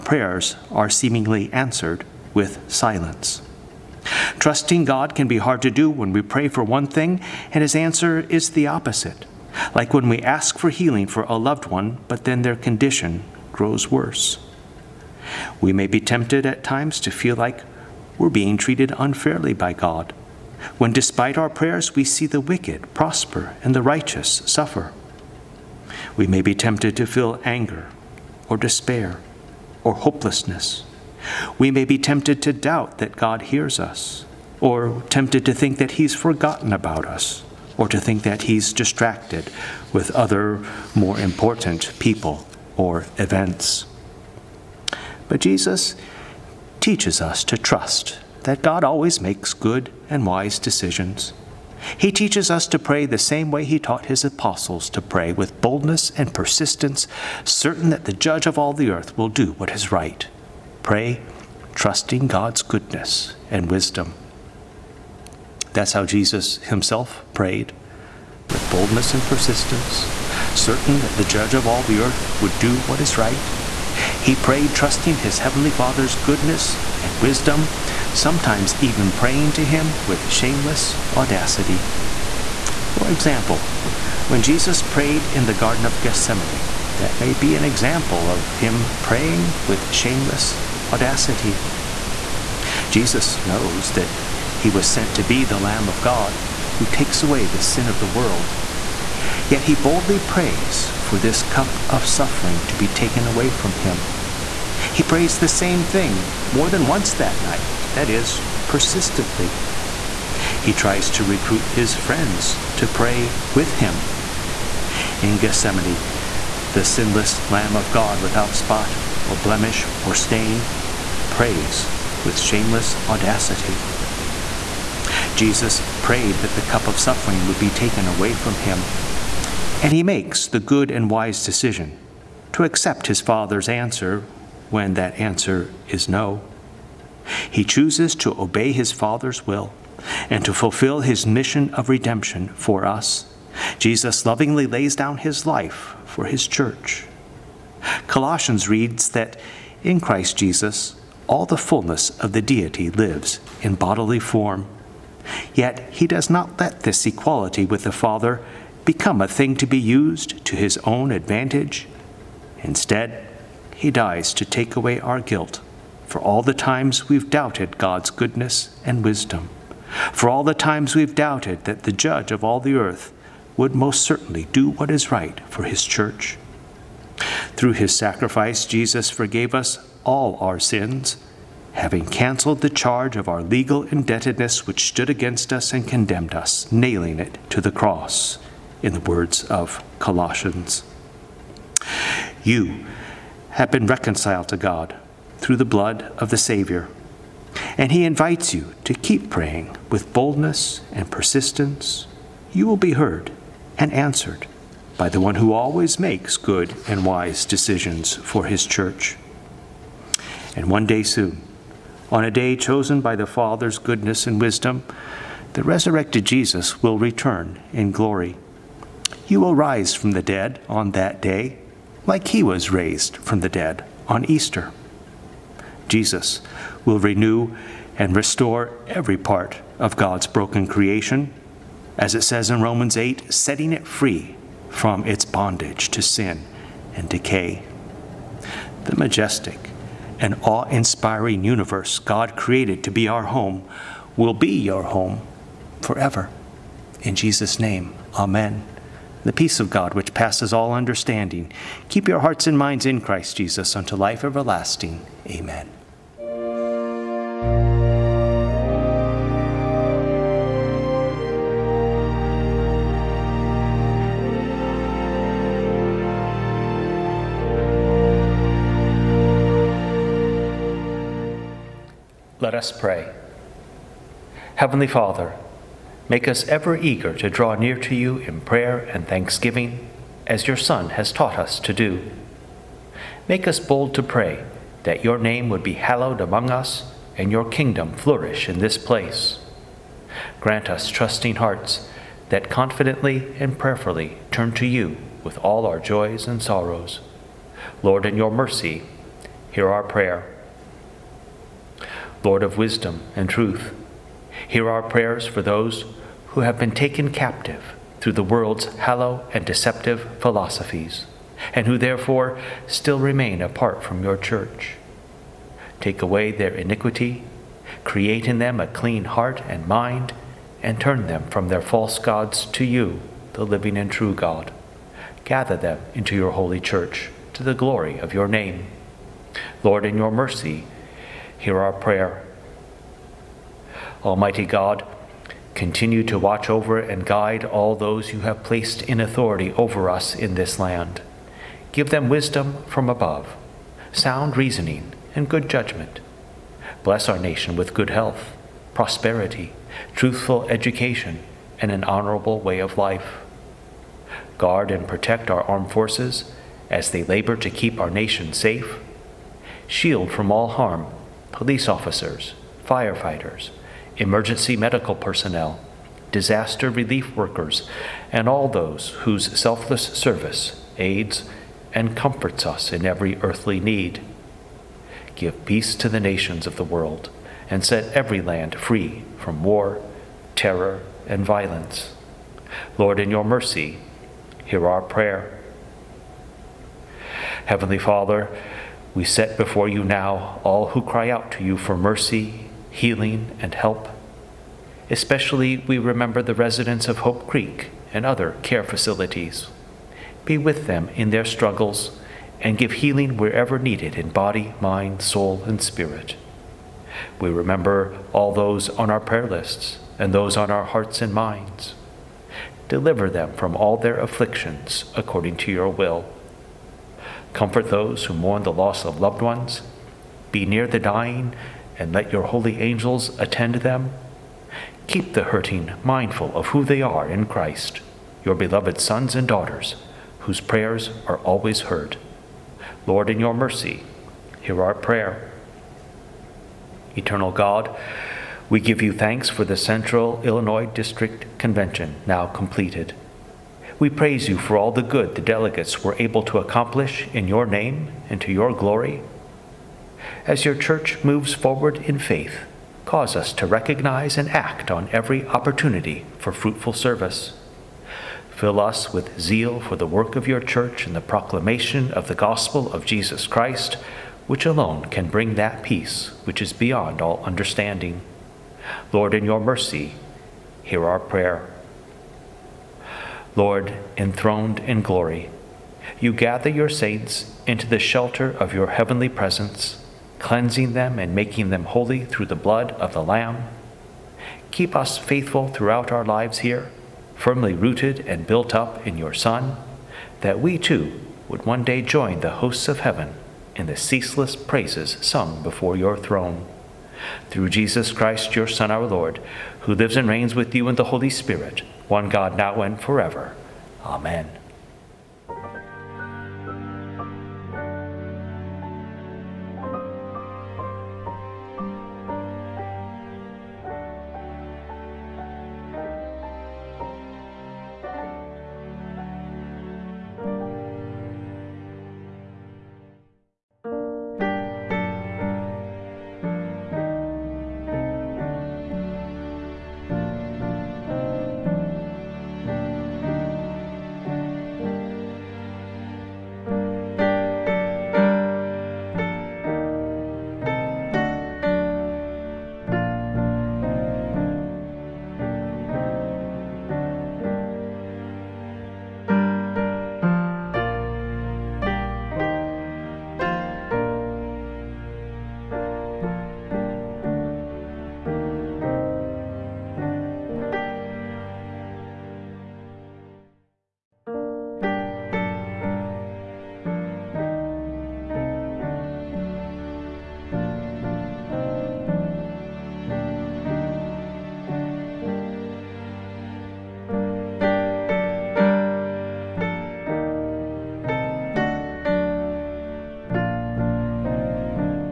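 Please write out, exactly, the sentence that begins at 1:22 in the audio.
For example, when Jesus prayed in the Garden of Gethsemane, that may be an example of him praying with shameless audacity.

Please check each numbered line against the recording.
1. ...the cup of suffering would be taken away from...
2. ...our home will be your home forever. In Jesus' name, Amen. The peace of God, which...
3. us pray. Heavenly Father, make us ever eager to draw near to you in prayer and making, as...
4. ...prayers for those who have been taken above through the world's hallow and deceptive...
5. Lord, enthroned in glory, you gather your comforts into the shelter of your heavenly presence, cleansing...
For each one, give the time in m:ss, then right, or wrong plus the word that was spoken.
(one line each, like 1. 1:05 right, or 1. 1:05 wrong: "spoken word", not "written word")
1. 2:06 right
2. 4:03 right
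3. 4:32 wrong: "thanksgiving", not "making"
4. 5:04 wrong: "captive", not "above"
5. 7:53 wrong: "saints", not "comforts".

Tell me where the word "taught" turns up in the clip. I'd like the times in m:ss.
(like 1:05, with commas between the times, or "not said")
0:53, 4:41.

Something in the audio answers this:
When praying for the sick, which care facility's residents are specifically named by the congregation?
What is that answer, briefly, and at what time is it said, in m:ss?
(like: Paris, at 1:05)
Hope Creek, at 6:36.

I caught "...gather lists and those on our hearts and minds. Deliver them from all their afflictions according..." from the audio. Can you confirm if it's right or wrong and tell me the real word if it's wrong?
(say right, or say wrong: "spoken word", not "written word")
wrong: "prayer", not "gather".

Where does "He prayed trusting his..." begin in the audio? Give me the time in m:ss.
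1:14.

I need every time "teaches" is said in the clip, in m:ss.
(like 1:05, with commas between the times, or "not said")
0:46, 0:52.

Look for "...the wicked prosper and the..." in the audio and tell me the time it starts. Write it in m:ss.
0:22.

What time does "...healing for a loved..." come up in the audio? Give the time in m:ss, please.
0:10.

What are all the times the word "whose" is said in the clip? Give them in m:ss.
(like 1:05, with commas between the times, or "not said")
6:09, 7:10.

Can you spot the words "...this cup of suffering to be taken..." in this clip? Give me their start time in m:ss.
1:41.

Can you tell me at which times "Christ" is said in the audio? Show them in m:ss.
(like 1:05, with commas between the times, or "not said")
2:29, 4:12, 7:07, 7:43, 8:17.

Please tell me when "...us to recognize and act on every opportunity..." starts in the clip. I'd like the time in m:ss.
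7:33.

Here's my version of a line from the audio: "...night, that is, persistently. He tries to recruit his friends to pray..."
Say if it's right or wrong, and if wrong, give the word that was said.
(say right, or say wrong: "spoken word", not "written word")
right.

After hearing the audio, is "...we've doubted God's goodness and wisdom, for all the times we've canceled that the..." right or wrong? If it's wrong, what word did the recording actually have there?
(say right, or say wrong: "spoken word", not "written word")
wrong: "doubted", not "canceled".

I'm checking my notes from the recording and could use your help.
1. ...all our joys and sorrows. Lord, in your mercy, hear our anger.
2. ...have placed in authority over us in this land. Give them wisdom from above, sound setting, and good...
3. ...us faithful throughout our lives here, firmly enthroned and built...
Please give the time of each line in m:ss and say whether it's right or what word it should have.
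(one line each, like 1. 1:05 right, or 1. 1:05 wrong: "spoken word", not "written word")
1. 4:55 wrong: "prayer", not "anger"
2. 5:38 wrong: "reasoning", not "setting"
3. 8:04 wrong: "rooted", not "enthroned".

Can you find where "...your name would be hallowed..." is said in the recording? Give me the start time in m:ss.
4:45.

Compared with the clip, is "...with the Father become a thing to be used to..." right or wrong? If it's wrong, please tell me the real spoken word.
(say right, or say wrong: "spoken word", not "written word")
right.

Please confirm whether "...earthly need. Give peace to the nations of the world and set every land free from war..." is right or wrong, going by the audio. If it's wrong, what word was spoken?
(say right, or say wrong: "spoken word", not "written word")
right.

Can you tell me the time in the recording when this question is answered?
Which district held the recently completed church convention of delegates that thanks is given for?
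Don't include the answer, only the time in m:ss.
7:19.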